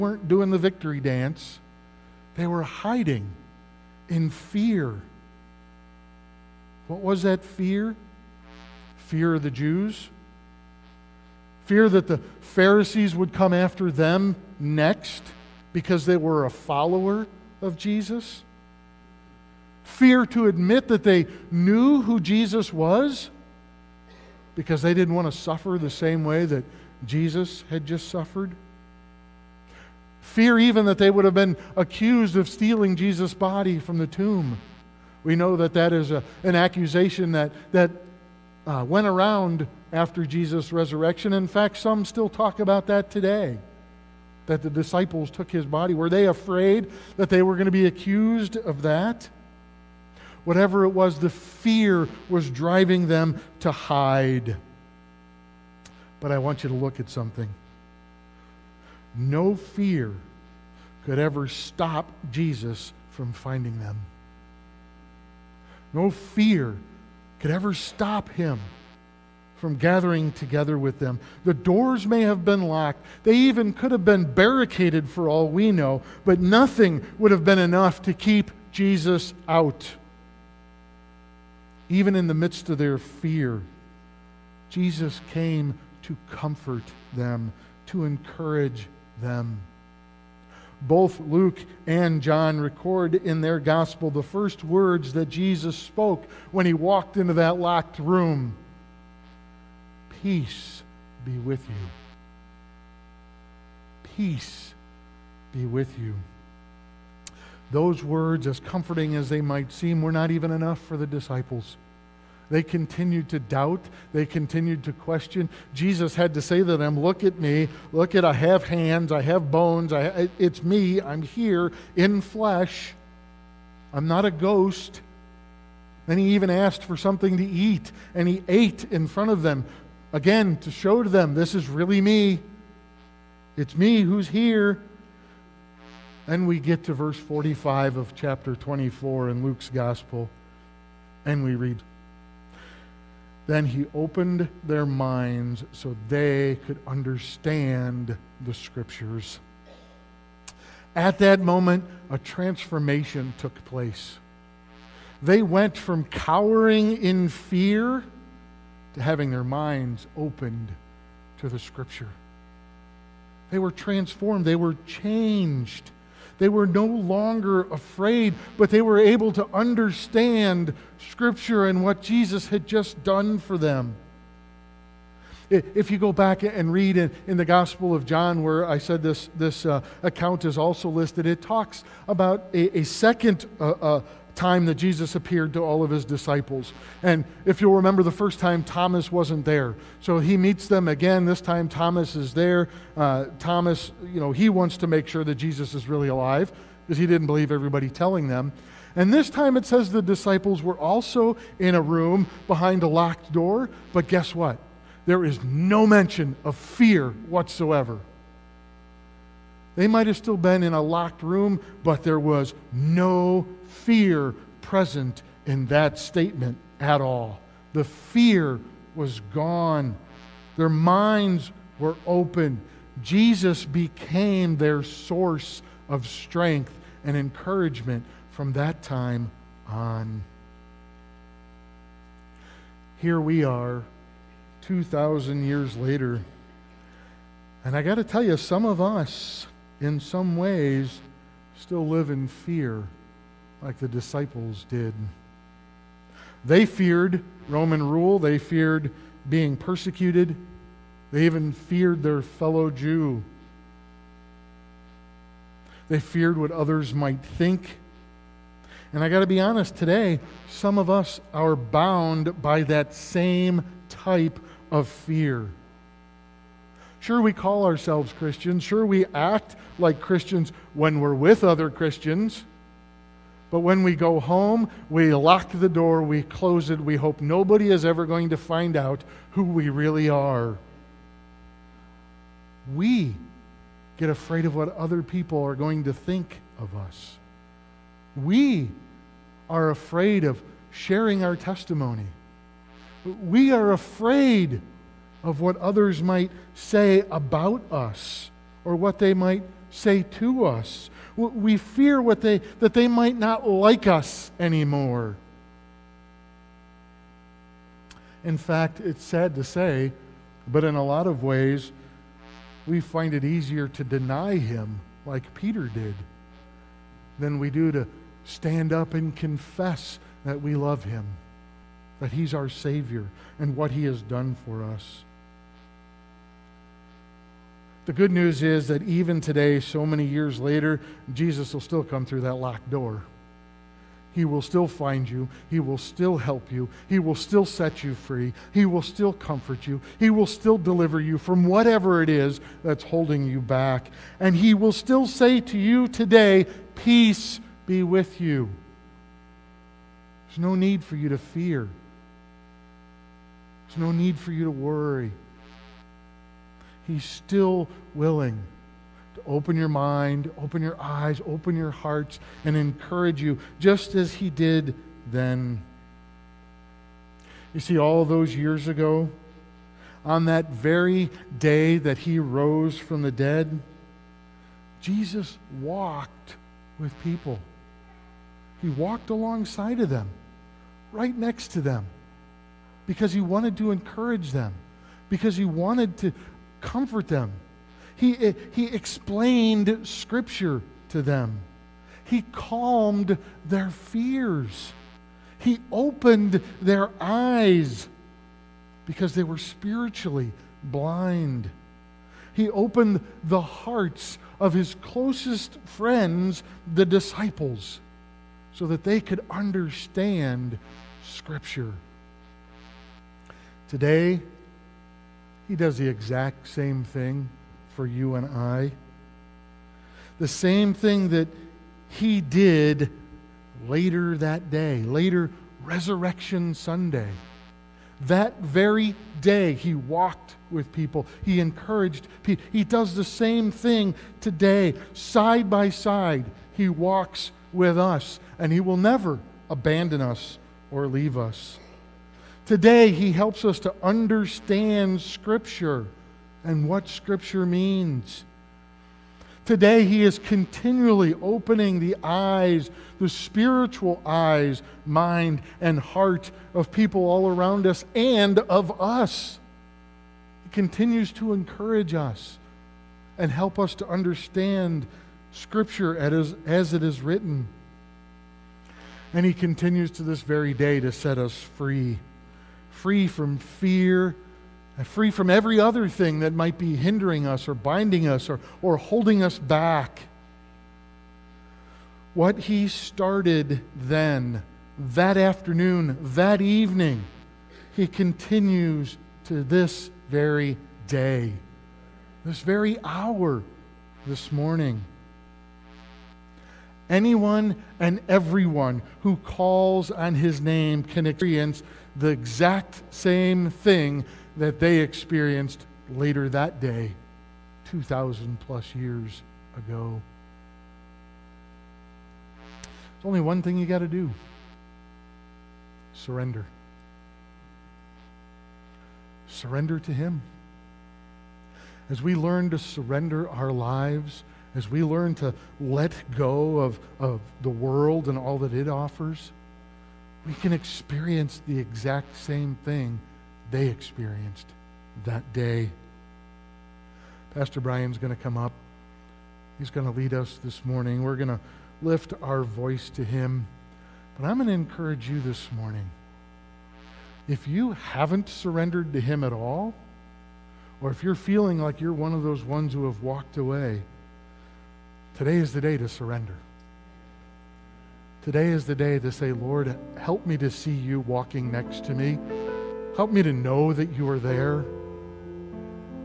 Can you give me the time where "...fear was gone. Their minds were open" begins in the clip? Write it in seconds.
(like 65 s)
217 s.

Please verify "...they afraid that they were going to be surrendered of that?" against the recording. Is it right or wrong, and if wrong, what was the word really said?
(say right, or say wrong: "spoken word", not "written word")
wrong: "accused", not "surrendered".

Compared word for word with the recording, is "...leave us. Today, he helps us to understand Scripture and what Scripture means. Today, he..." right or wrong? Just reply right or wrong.
right.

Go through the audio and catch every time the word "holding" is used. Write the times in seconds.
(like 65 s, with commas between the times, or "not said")
342 s, 478 s.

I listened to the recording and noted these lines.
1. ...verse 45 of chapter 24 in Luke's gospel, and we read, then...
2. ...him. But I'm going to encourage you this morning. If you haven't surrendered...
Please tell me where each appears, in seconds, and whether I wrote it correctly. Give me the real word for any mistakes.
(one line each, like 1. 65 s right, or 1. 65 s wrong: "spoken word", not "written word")
1. 136 s right
2. 543 s right.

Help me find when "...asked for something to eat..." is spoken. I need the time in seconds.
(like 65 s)
126 s.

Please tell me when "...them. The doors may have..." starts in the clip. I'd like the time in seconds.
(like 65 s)
70 s.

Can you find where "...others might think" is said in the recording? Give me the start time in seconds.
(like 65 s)
256 s.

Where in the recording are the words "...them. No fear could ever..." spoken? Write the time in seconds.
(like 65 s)
63 s.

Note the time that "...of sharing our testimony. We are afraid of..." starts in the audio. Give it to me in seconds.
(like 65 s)
290 s.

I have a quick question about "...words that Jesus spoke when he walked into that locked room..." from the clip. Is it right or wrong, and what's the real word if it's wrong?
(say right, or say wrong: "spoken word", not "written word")
right.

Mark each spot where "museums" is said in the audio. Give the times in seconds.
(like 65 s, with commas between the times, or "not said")
not said.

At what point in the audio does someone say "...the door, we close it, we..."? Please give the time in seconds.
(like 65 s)
275 s.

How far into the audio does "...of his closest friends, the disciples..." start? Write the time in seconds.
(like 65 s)
404 s.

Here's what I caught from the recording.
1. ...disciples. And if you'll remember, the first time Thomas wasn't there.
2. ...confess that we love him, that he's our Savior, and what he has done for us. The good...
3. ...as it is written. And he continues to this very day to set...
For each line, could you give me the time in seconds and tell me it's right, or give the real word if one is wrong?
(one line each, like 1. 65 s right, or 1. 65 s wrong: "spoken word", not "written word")
1. 186 s right
2. 319 s right
3. 466 s right.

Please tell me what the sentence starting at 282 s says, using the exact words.
We get afraid of what other people are going to think of us.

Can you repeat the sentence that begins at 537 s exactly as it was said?
Pastor Brian's going to come up.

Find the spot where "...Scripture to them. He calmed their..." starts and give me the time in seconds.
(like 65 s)
389 s.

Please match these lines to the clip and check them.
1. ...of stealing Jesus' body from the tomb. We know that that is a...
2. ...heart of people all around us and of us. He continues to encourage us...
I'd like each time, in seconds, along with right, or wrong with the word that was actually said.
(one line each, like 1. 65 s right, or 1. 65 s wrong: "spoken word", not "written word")
1. 32 s right
2. 455 s right.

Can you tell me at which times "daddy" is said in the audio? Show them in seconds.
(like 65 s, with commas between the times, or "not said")
not said.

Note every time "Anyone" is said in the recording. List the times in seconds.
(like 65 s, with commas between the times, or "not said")
496 s.